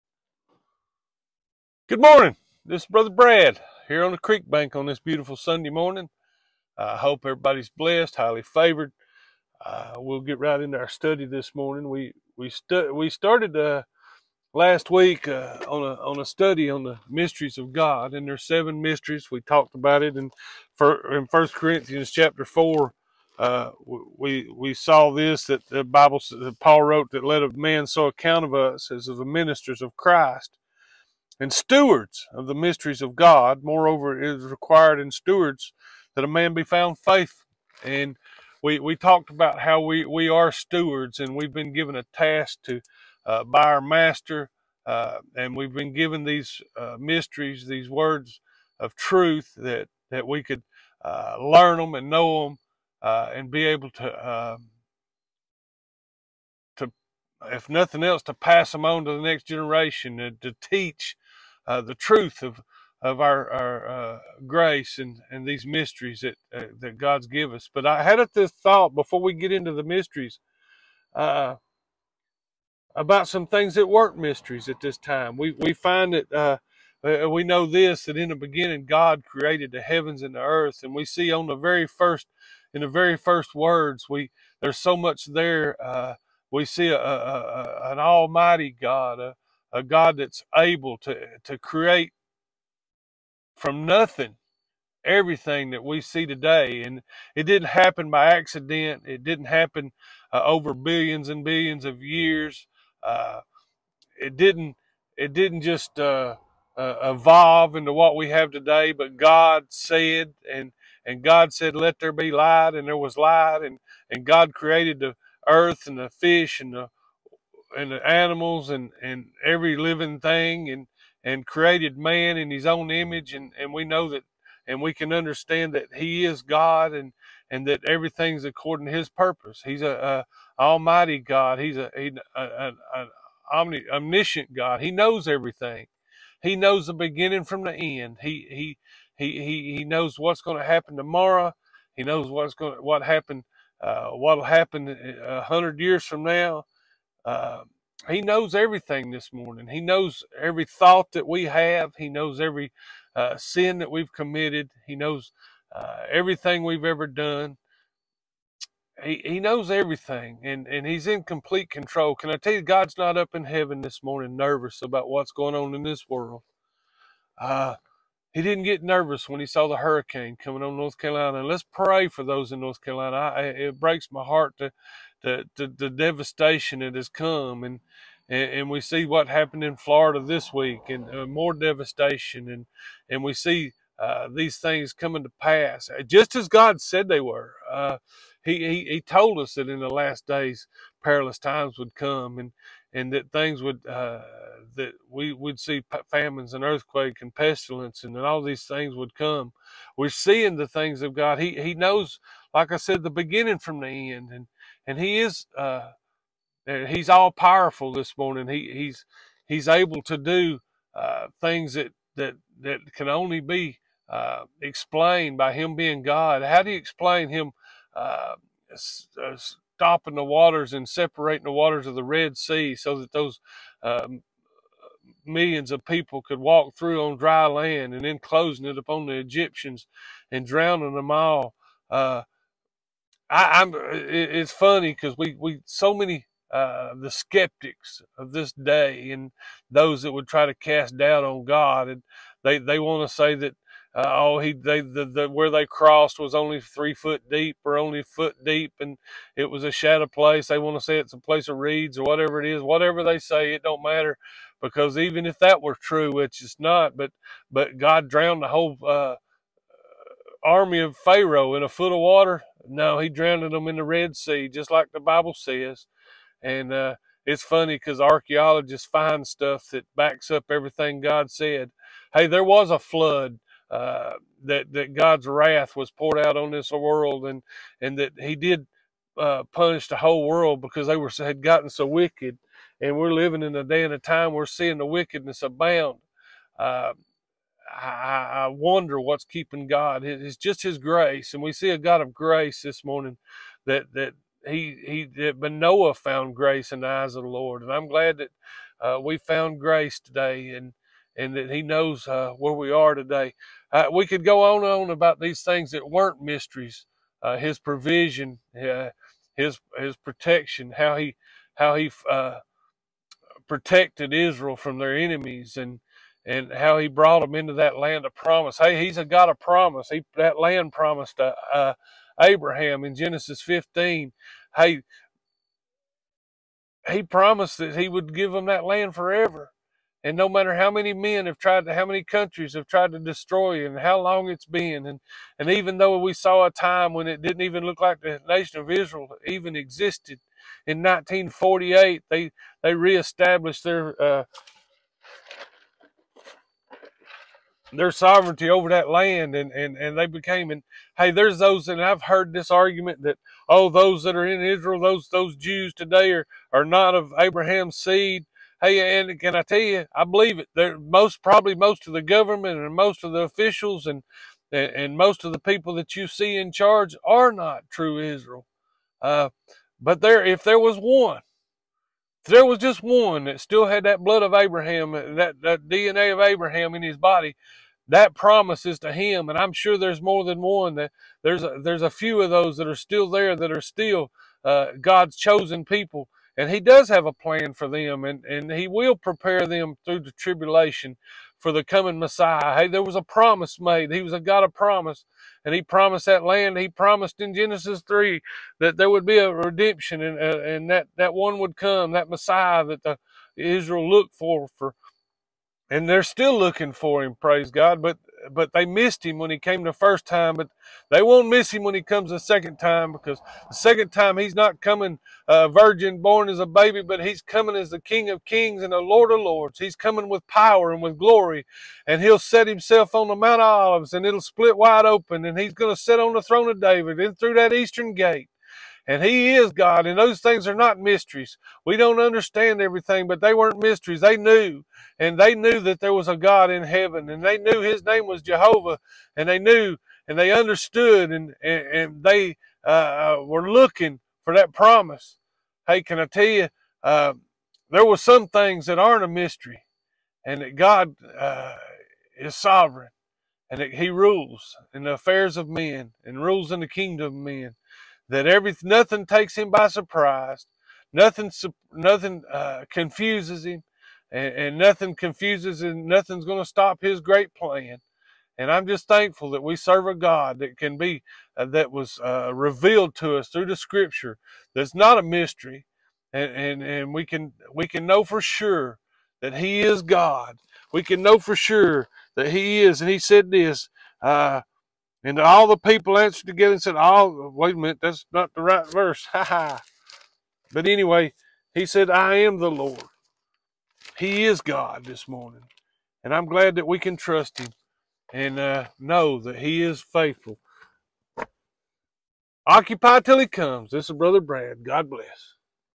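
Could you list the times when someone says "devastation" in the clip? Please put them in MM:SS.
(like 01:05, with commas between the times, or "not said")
02:55, 03:01.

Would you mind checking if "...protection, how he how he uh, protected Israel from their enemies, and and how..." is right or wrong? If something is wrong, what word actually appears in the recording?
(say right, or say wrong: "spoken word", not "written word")
right.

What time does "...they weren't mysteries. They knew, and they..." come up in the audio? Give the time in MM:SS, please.
07:13.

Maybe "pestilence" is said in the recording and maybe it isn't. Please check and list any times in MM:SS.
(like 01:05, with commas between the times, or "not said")
03:17.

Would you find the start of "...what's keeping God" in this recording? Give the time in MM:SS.
04:48.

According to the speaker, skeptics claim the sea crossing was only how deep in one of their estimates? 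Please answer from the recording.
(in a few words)
3 feet.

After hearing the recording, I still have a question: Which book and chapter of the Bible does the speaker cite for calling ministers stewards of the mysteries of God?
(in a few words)
First Corinthians 4.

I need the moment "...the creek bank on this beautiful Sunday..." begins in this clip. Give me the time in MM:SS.
00:04.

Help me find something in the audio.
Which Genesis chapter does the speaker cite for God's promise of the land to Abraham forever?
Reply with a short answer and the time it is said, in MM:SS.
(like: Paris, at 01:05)
Genesis 15, at 05:22.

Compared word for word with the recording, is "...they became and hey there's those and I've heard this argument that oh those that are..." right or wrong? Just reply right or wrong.
right.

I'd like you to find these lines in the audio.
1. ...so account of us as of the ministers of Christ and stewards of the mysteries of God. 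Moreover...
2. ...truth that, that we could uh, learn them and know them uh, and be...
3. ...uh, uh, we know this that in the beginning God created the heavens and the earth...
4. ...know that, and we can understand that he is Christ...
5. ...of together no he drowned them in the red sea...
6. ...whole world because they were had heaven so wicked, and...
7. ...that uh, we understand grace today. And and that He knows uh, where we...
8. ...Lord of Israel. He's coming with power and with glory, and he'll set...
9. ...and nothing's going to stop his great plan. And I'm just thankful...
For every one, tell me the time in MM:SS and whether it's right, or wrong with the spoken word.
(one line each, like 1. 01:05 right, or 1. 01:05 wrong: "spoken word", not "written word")
1. 00:27 right
2. 00:48 right
3. 01:16 right
4. 02:03 wrong: "God", not "Christ"
5. 04:21 wrong: "water", not "together"
6. 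04:39 wrong: "gotten", not "heaven"
7. 04:58 wrong: "found", not "understand"
8. 06:58 wrong: "Lords", not "Israel"
9. 07:45 right.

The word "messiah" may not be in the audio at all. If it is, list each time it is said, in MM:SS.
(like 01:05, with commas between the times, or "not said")
06:31, 06:42.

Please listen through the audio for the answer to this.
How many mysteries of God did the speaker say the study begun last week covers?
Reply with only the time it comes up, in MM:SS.
00:18.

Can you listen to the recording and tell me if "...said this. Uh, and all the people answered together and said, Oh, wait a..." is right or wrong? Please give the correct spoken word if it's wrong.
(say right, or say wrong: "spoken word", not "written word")
right.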